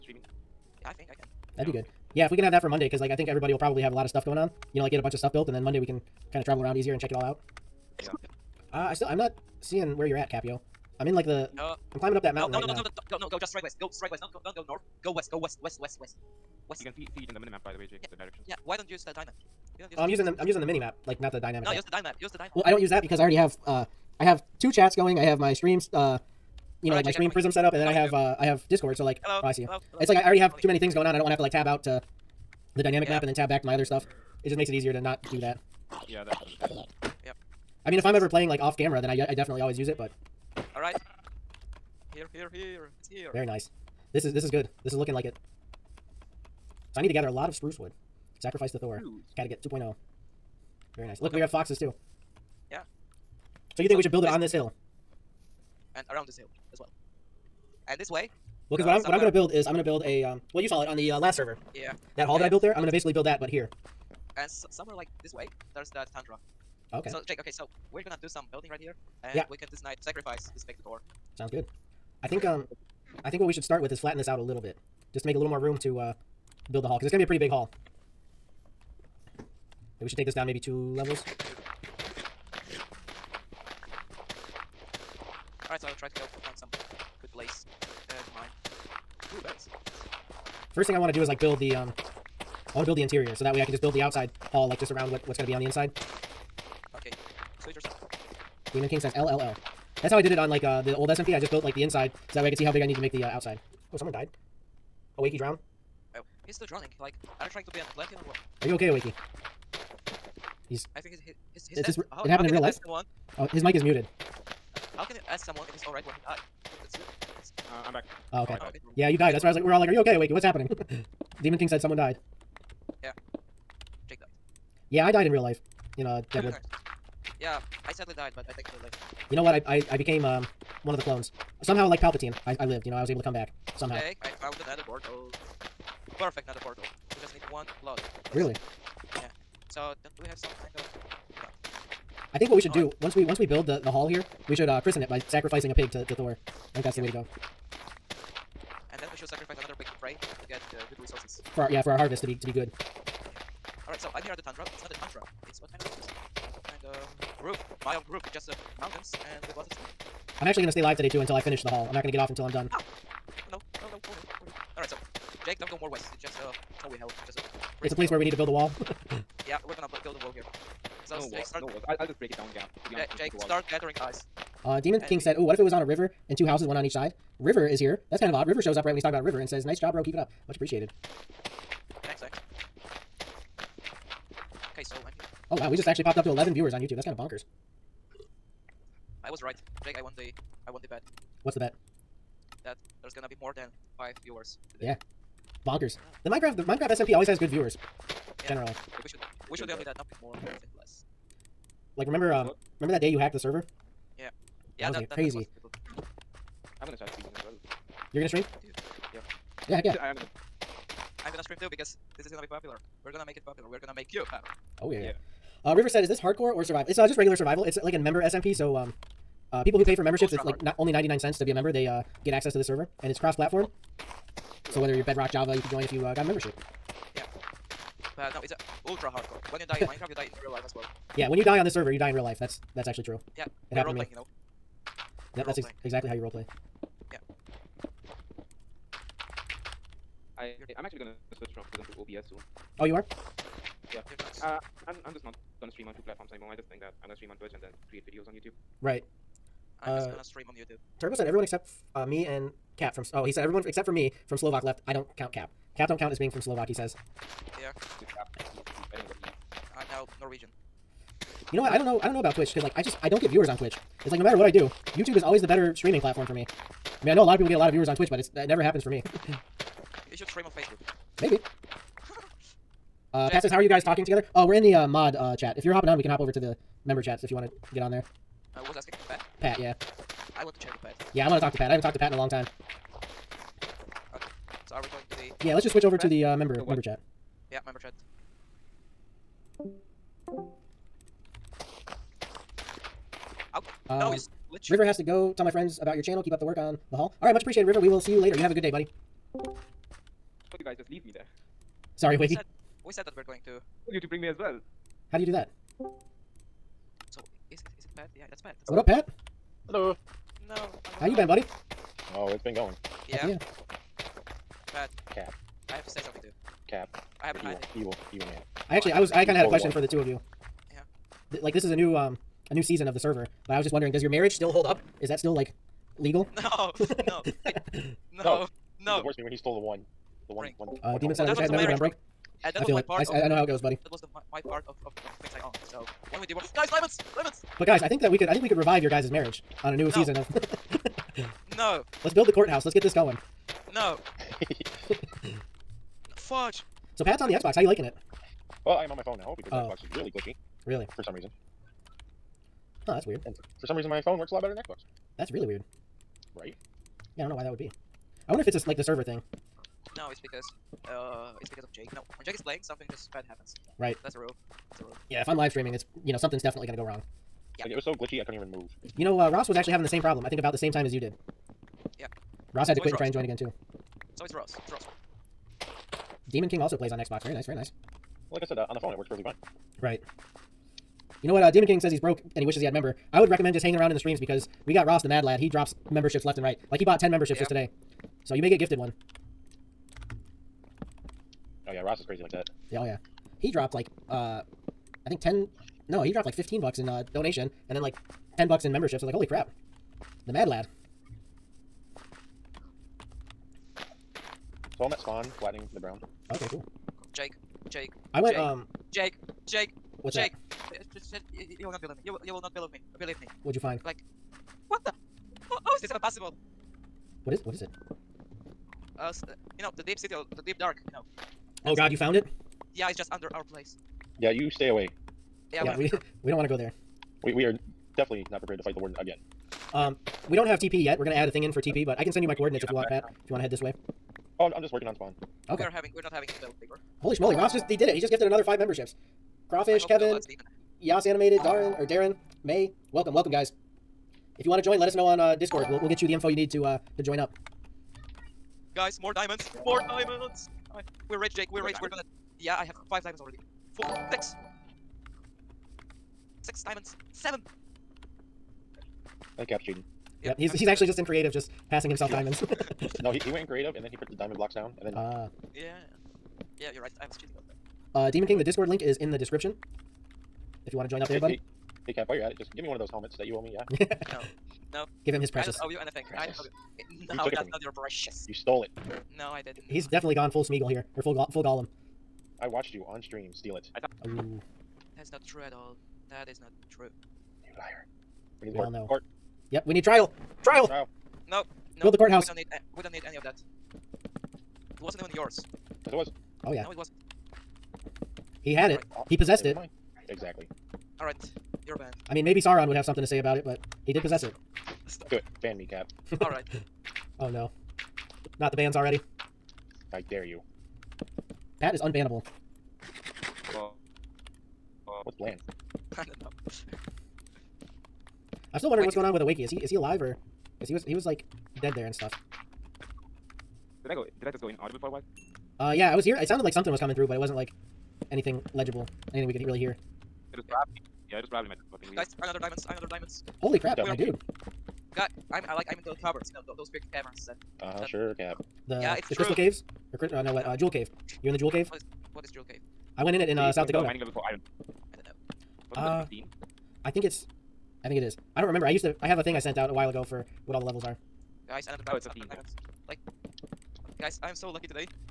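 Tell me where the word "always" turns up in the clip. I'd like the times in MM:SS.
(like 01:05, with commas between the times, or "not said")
00:39, 03:17, 04:25.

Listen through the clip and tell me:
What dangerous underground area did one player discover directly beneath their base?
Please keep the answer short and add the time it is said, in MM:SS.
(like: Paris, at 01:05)
the deep dark, at 07:00.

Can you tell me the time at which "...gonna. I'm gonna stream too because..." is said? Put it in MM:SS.
03:30.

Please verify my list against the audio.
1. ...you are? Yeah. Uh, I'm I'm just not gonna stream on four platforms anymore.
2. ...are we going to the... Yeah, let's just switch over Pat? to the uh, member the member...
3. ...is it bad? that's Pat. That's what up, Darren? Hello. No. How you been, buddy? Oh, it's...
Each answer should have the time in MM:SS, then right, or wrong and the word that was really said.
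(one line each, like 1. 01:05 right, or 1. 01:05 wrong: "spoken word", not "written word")
1. 04:02 wrong: "two", not "four"
2. 04:44 right
3. 05:07 wrong: "Pat", not "Darren".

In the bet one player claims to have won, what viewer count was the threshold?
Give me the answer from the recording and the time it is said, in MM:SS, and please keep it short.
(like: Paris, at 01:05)
5, at 03:13.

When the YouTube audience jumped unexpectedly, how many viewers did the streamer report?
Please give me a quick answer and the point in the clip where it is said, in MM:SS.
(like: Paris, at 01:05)
11, at 03:06.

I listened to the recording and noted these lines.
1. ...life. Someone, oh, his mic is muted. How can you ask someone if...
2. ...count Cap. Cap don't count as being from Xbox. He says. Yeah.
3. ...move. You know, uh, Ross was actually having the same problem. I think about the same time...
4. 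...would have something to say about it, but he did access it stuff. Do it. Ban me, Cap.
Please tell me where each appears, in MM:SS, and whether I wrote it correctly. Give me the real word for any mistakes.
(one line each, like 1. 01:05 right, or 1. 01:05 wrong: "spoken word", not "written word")
1. 01:52 right
2. 04:15 wrong: "Slovak", not "Xbox"
3. 06:08 right
4. 08:22 wrong: "possess", not "access".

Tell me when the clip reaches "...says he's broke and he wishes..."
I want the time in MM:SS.
06:21.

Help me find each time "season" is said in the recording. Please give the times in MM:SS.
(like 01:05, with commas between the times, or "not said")
05:22, 05:39.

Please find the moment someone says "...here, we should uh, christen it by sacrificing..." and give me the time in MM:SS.
02:24.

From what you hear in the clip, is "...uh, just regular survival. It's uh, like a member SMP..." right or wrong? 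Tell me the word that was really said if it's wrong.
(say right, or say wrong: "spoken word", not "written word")
right.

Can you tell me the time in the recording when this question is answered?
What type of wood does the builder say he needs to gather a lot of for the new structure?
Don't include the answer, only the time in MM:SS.
00:47.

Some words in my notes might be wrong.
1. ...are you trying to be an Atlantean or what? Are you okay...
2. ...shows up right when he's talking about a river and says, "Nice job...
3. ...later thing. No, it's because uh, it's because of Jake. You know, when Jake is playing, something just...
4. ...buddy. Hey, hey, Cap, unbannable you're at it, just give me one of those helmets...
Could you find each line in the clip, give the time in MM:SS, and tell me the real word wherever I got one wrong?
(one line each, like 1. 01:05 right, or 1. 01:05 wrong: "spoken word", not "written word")
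1. 01:47 right
2. 02:58 right
3. 05:58 wrong: "server", not "later"
4. 07:51 wrong: "while", not "unbannable".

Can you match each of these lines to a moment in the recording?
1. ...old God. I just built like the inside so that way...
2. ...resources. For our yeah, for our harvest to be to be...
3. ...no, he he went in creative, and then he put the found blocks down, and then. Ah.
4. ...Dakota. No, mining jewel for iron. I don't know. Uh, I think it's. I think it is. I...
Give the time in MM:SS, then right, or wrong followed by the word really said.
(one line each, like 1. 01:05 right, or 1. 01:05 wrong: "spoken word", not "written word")
1. 01:40 wrong: "SMP", not "God"
2. 02:31 right
3. 07:43 wrong: "diamond", not "found"
4. 09:03 wrong: "level", not "jewel".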